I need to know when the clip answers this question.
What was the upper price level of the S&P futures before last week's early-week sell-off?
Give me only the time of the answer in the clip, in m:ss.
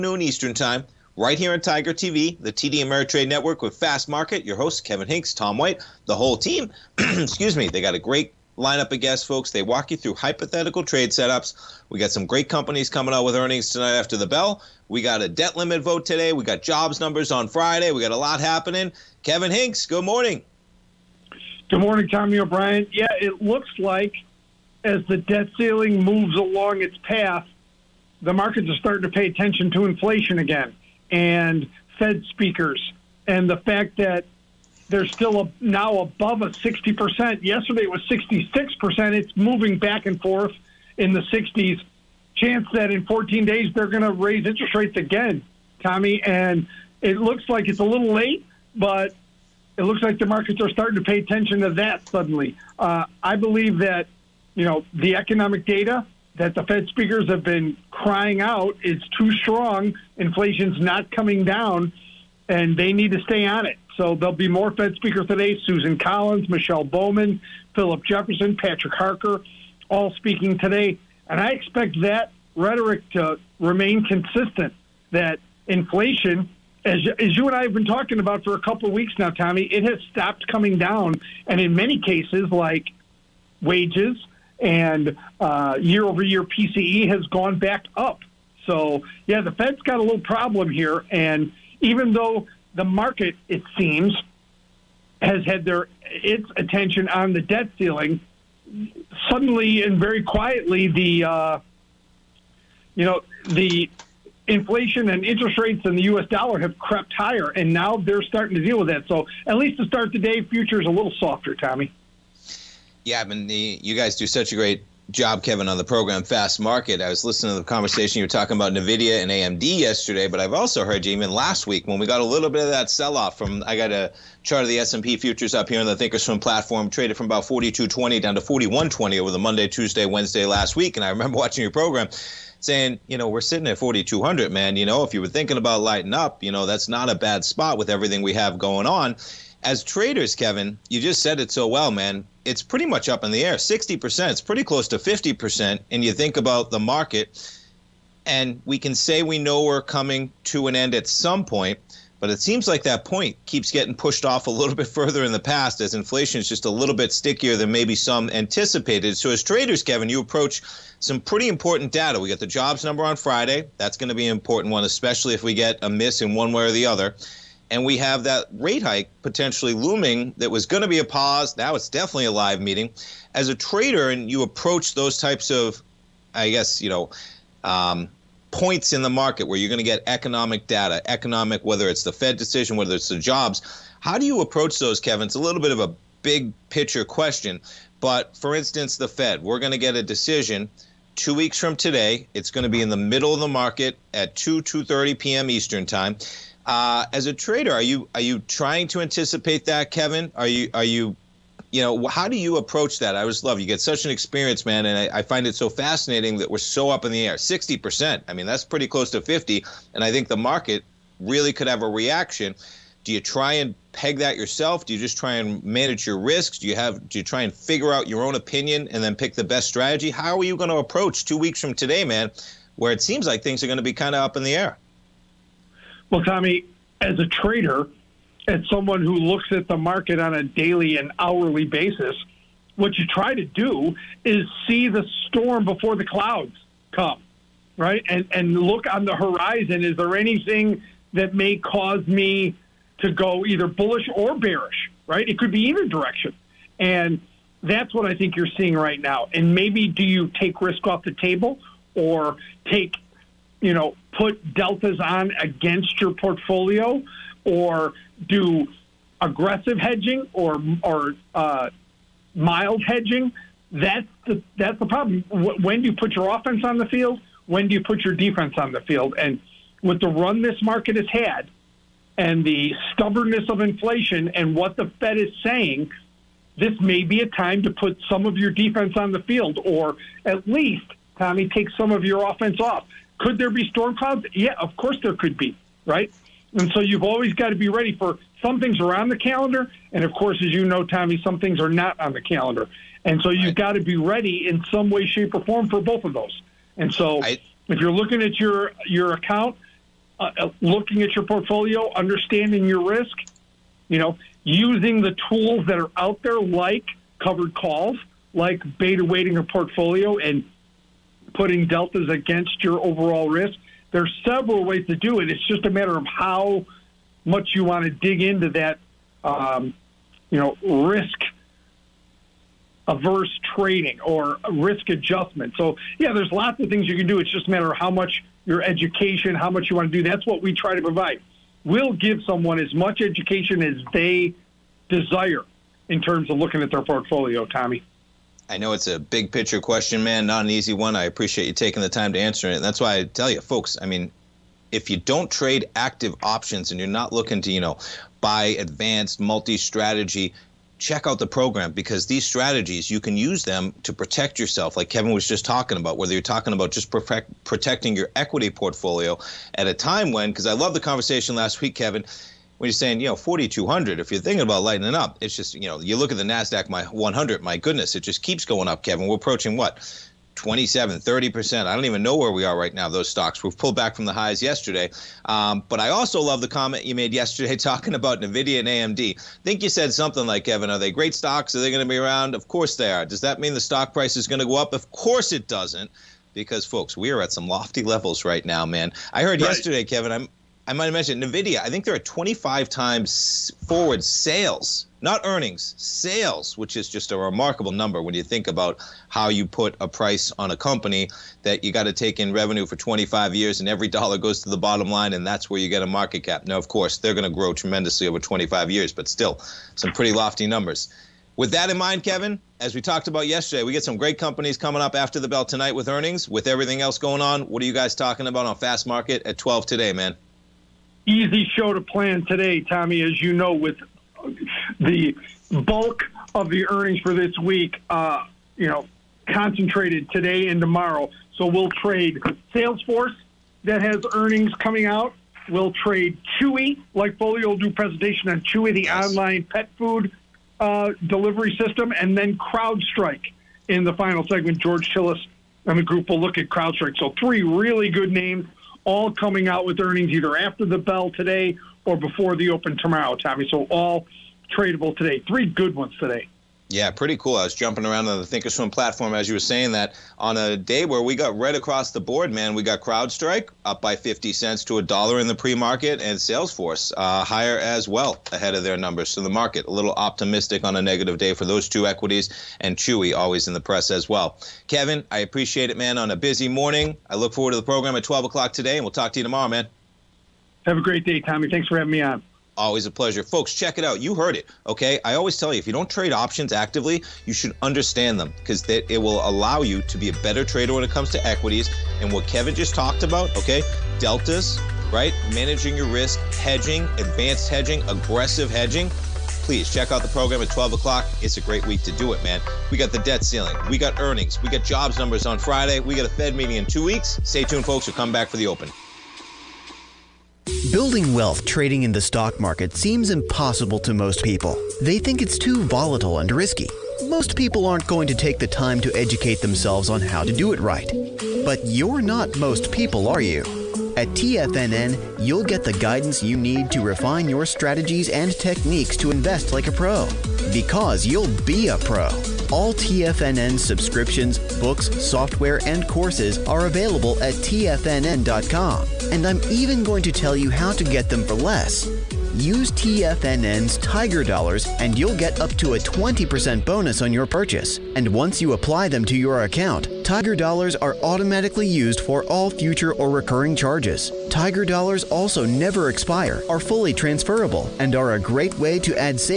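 2:07.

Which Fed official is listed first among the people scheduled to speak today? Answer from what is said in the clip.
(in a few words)
Susan Collins.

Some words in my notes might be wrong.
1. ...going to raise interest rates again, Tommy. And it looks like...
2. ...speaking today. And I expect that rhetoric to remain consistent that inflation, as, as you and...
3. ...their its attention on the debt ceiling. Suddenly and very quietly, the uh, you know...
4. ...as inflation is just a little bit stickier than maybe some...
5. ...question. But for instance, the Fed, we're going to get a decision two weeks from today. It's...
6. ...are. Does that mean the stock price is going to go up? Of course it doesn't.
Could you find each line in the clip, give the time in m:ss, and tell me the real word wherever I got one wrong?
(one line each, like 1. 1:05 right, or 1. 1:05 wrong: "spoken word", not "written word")
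1. 0:43 right
2. 1:10 right
3. 1:35 right
4. 2:35 right
5. 3:07 right
6. 6:22 right.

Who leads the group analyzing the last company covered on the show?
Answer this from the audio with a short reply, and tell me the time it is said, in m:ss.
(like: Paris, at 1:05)
George Tillis, at 7:24.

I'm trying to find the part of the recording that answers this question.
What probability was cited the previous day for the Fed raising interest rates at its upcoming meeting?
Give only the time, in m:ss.
0:38.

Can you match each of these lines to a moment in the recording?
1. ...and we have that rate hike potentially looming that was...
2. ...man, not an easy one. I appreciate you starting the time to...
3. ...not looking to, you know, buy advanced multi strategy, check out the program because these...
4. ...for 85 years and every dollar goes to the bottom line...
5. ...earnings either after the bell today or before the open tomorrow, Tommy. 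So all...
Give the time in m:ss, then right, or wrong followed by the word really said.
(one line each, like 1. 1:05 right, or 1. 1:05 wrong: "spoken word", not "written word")
1. 2:47 right
2. 5:40 wrong: "taking", not "starting"
3. 5:46 right
4. 6:42 wrong: "25", not "85"
5. 7:29 right.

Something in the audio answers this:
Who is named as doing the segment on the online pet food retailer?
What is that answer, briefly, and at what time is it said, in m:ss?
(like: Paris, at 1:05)
Foley, at 7:17.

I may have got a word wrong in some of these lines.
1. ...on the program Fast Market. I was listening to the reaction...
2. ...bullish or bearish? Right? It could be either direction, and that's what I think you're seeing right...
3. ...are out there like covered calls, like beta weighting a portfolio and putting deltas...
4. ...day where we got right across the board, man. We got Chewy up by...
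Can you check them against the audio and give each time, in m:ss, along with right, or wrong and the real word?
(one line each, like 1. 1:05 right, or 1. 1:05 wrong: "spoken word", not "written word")
1. 1:55 wrong: "conversation", not "reaction"
2. 4:03 right
3. 5:05 right
4. 7:40 wrong: "CrowdStrike", not "Chewy".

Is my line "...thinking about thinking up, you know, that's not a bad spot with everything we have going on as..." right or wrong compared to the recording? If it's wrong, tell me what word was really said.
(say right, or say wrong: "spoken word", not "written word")
wrong: "lighting", not "thinking".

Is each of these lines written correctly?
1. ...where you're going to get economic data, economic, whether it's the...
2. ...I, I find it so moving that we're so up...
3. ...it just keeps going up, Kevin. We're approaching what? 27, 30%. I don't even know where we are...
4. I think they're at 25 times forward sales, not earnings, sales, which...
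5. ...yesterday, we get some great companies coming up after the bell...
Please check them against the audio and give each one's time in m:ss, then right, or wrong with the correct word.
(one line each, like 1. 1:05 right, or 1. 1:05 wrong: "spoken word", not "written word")
1. 2:59 right
2. 3:25 wrong: "fascinating", not "moving"
3. 6:07 right
4. 6:31 right
5. 6:53 right.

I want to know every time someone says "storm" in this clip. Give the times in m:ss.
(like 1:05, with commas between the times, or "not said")
3:55, 4:43.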